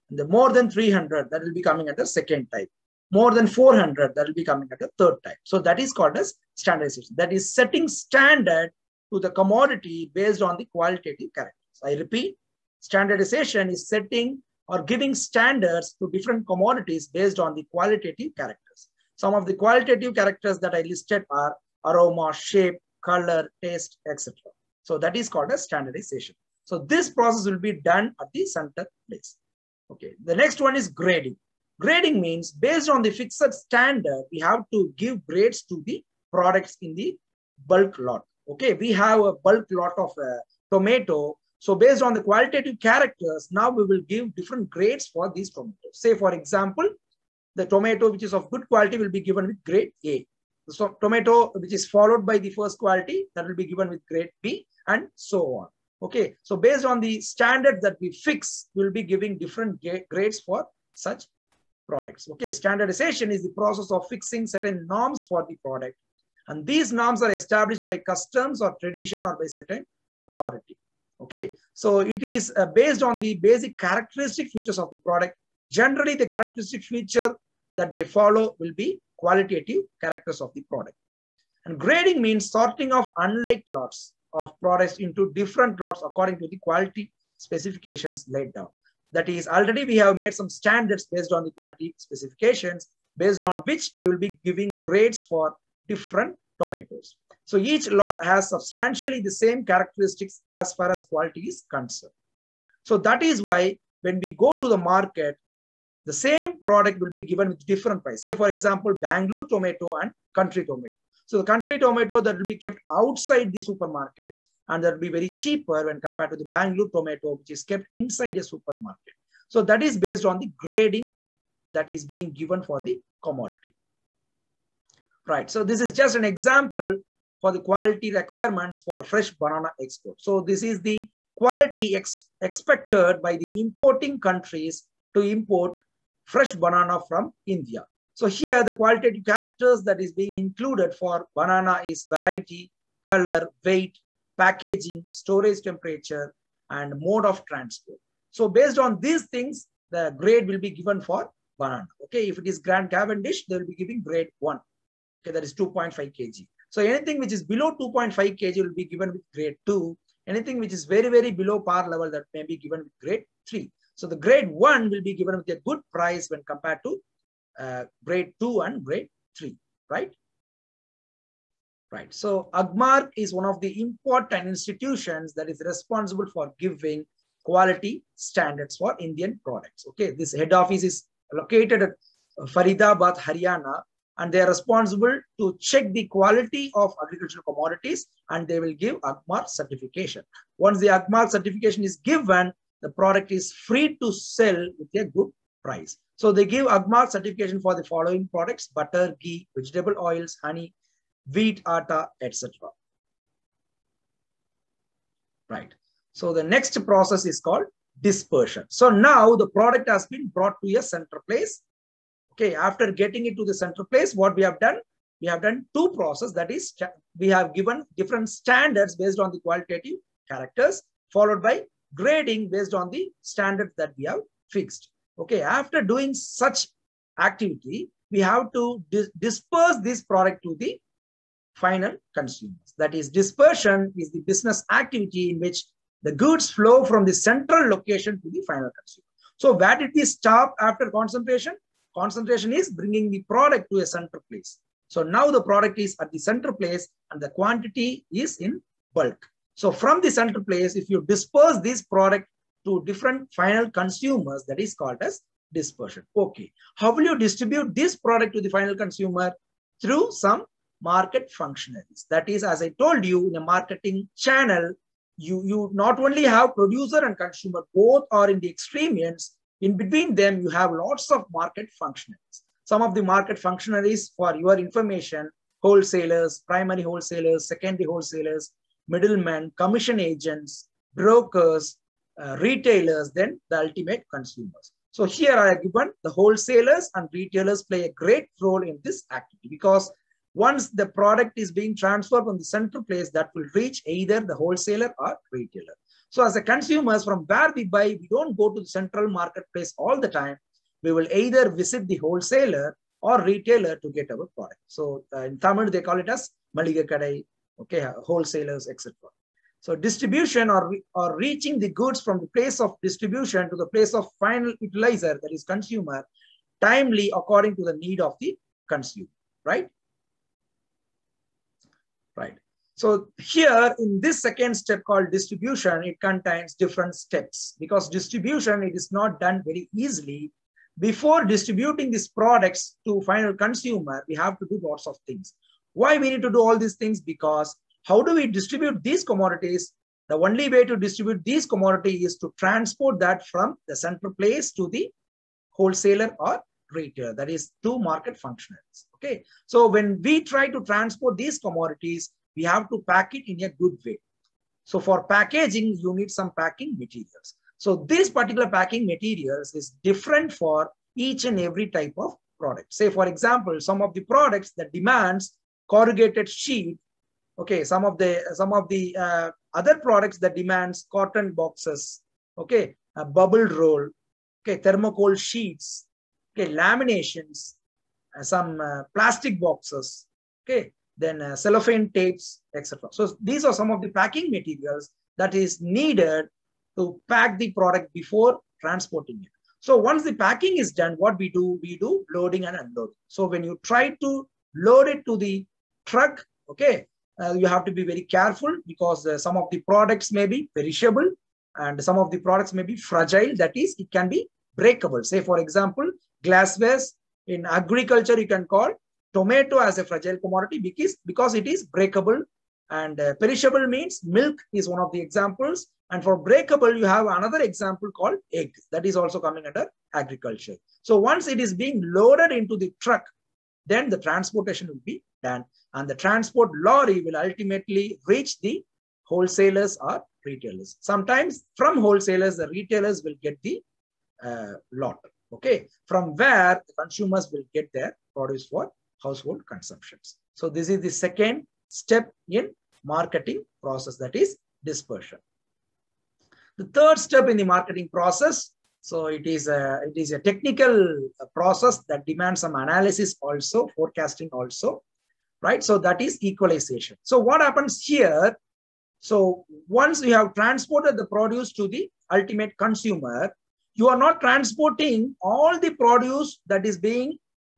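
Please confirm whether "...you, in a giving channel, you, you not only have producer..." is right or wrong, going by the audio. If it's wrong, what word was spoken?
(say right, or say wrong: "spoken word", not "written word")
wrong: "marketing", not "giving".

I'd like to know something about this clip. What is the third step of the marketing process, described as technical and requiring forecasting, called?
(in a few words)
equalization.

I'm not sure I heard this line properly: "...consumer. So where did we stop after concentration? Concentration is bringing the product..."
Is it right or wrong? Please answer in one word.
right.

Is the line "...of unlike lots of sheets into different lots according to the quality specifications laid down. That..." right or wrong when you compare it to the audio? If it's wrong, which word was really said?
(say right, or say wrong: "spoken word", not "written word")
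wrong: "products", not "sheets".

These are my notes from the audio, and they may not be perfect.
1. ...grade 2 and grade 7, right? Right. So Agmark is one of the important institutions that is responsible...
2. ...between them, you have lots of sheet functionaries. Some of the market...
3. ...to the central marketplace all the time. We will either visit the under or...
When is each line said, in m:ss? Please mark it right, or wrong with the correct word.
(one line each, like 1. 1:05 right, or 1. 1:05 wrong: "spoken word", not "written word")
1. 2:48 wrong: "3", not "7"
2. 4:29 wrong: "market", not "sheet"
3. 4:58 wrong: "wholesaler", not "under".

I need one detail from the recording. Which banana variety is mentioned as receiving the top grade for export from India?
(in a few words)
Grand Cavendish.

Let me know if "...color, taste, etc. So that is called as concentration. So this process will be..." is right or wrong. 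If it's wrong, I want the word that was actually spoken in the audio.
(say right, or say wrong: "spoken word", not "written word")
wrong: "standardization", not "concentration".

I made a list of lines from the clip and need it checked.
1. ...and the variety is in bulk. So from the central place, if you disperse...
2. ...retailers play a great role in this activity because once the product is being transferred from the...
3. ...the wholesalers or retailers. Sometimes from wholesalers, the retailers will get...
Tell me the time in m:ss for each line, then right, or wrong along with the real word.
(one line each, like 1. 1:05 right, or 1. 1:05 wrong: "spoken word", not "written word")
1. 4:07 wrong: "quantity", not "variety"
2. 4:47 right
3. 7:08 right.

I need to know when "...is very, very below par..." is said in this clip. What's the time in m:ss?
2:40.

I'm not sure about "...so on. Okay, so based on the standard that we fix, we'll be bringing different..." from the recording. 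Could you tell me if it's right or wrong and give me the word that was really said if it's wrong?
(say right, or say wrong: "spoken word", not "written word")
wrong: "giving", not "bringing".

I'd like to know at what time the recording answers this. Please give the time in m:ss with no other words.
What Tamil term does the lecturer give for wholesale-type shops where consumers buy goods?
5:06.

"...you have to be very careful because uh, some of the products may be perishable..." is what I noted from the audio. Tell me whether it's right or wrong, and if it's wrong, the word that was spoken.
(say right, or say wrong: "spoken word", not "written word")
right.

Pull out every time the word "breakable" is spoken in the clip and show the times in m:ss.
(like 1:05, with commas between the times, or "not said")
6:44, 6:51, 6:56.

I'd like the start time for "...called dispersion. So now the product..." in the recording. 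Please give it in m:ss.
3:27.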